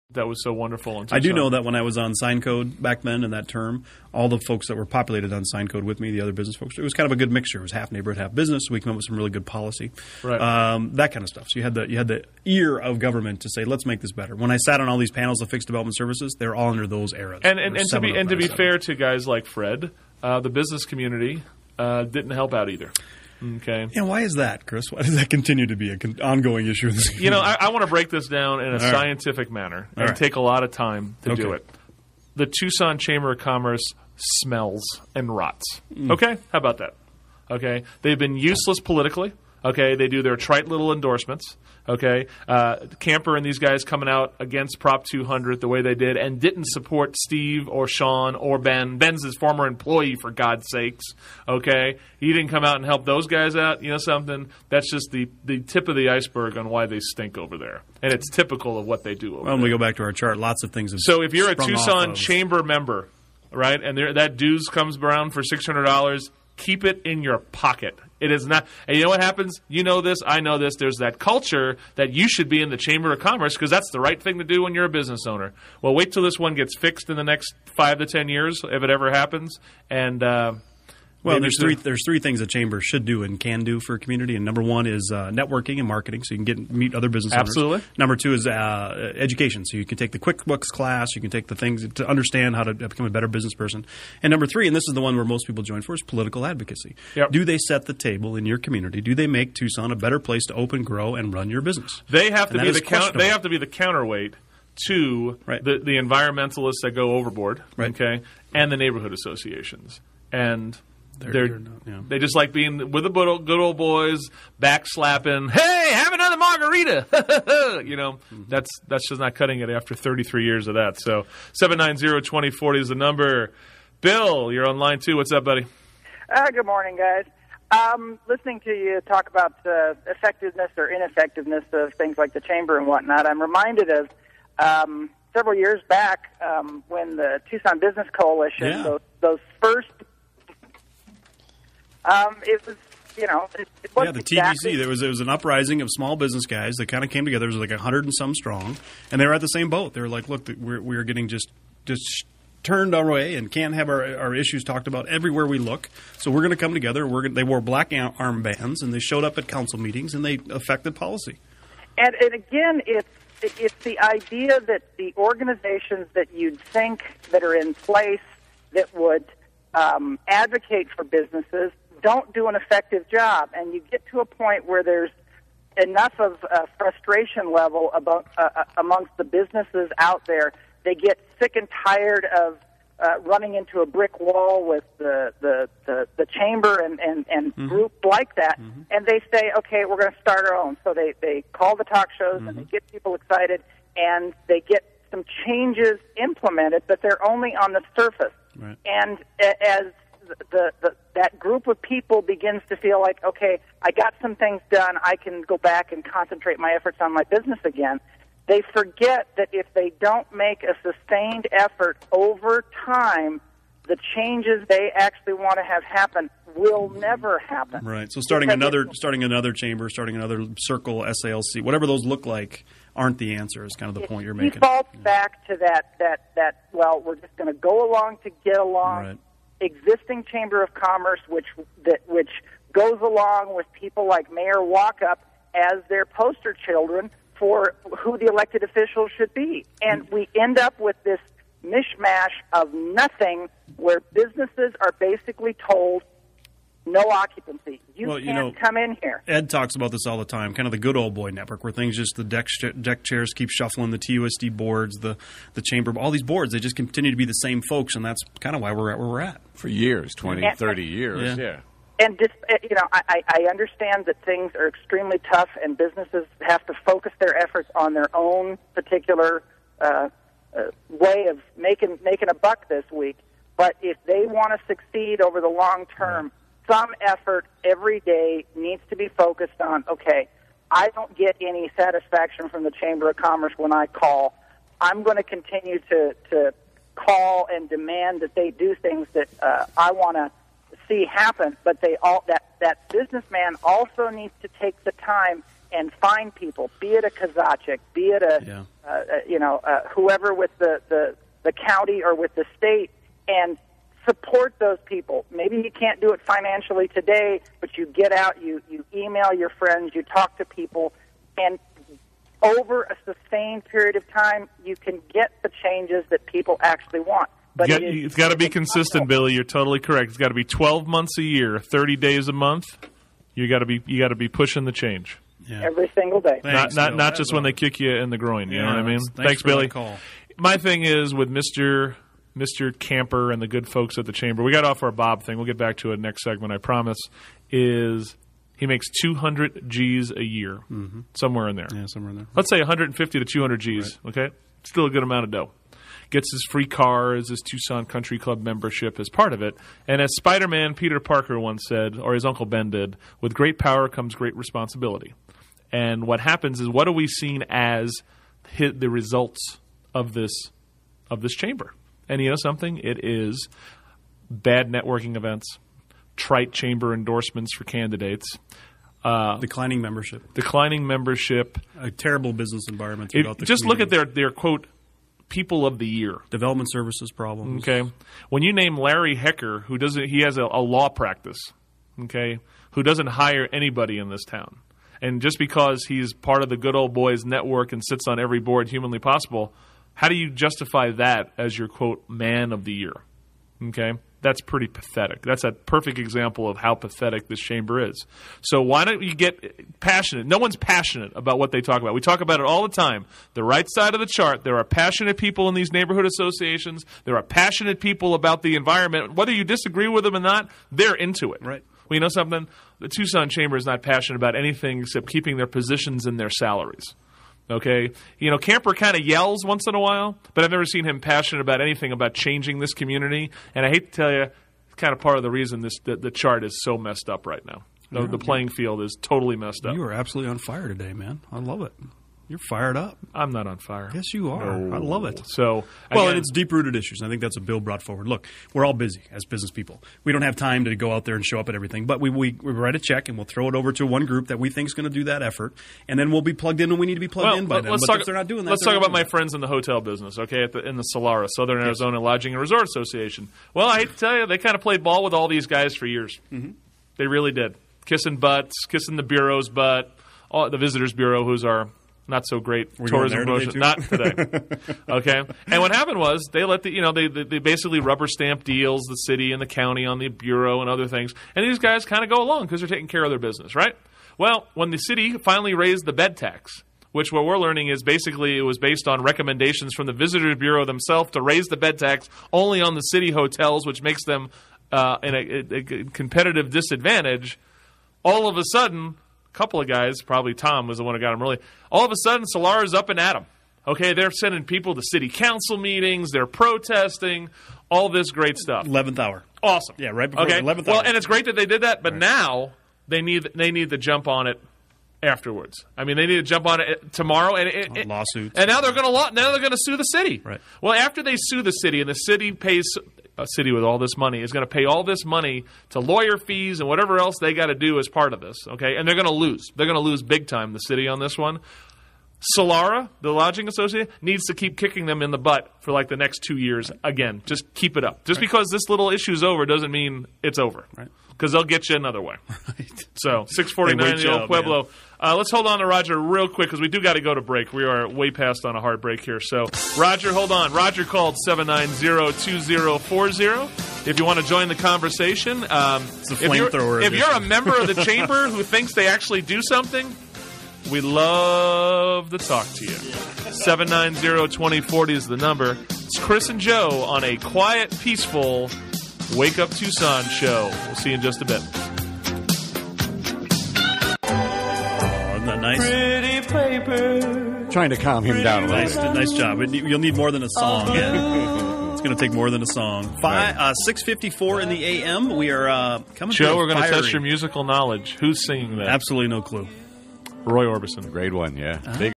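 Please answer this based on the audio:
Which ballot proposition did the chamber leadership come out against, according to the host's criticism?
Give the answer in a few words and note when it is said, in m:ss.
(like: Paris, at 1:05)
Prop 200, at 0:44.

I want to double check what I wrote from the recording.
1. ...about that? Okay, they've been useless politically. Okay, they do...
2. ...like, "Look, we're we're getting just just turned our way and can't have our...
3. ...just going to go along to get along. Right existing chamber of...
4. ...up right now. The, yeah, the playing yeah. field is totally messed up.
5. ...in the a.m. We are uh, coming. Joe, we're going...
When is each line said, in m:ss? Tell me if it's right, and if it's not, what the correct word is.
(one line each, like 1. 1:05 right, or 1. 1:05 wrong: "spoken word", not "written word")
1. 0:36 right
2. 2:30 right
3. 3:47 right
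4. 7:07 right
5. 9:34 right.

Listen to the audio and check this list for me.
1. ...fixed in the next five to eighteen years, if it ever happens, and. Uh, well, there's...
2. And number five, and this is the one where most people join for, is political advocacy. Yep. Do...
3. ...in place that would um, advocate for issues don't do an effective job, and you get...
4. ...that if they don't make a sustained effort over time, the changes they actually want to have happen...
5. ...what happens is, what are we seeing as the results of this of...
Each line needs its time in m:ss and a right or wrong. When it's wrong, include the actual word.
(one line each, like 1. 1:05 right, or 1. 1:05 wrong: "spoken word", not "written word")
1. 1:16 wrong: "ten", not "eighteen"
2. 1:34 wrong: "three", not "five"
3. 2:47 wrong: "businesses", not "issues"
4. 3:29 right
5. 5:56 right.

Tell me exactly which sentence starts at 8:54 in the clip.
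Uh, let's hold on to Roger real quick because we do got to go to break.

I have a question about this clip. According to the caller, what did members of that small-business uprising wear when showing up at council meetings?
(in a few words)
black armbands.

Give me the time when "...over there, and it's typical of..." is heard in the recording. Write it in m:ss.
0:57.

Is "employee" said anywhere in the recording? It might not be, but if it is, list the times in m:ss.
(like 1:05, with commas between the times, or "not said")
0:49.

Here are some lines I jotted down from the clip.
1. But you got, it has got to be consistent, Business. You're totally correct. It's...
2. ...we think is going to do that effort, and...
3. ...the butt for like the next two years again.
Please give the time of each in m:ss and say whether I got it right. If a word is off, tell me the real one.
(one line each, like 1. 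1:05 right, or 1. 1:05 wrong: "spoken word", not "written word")
1. 5:17 wrong: "Billy", not "Business"
2. 7:24 right
3. 8:45 right.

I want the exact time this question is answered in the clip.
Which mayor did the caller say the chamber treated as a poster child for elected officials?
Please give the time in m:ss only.
3:54.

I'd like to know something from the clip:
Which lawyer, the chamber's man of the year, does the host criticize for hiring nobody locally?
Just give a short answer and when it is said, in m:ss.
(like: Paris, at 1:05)
Larry Hecker, at 6:18.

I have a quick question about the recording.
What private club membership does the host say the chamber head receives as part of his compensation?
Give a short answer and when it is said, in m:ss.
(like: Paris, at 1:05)
Tucson Country Club, at 5:47.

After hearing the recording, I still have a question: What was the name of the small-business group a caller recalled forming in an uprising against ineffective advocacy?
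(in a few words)
Tucson Business Coalition.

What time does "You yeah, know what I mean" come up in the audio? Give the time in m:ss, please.
5:28.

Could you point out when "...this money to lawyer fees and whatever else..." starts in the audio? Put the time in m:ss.
8:34.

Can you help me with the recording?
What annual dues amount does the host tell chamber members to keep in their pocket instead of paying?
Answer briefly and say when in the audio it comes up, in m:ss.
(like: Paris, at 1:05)
$600, at 1:05.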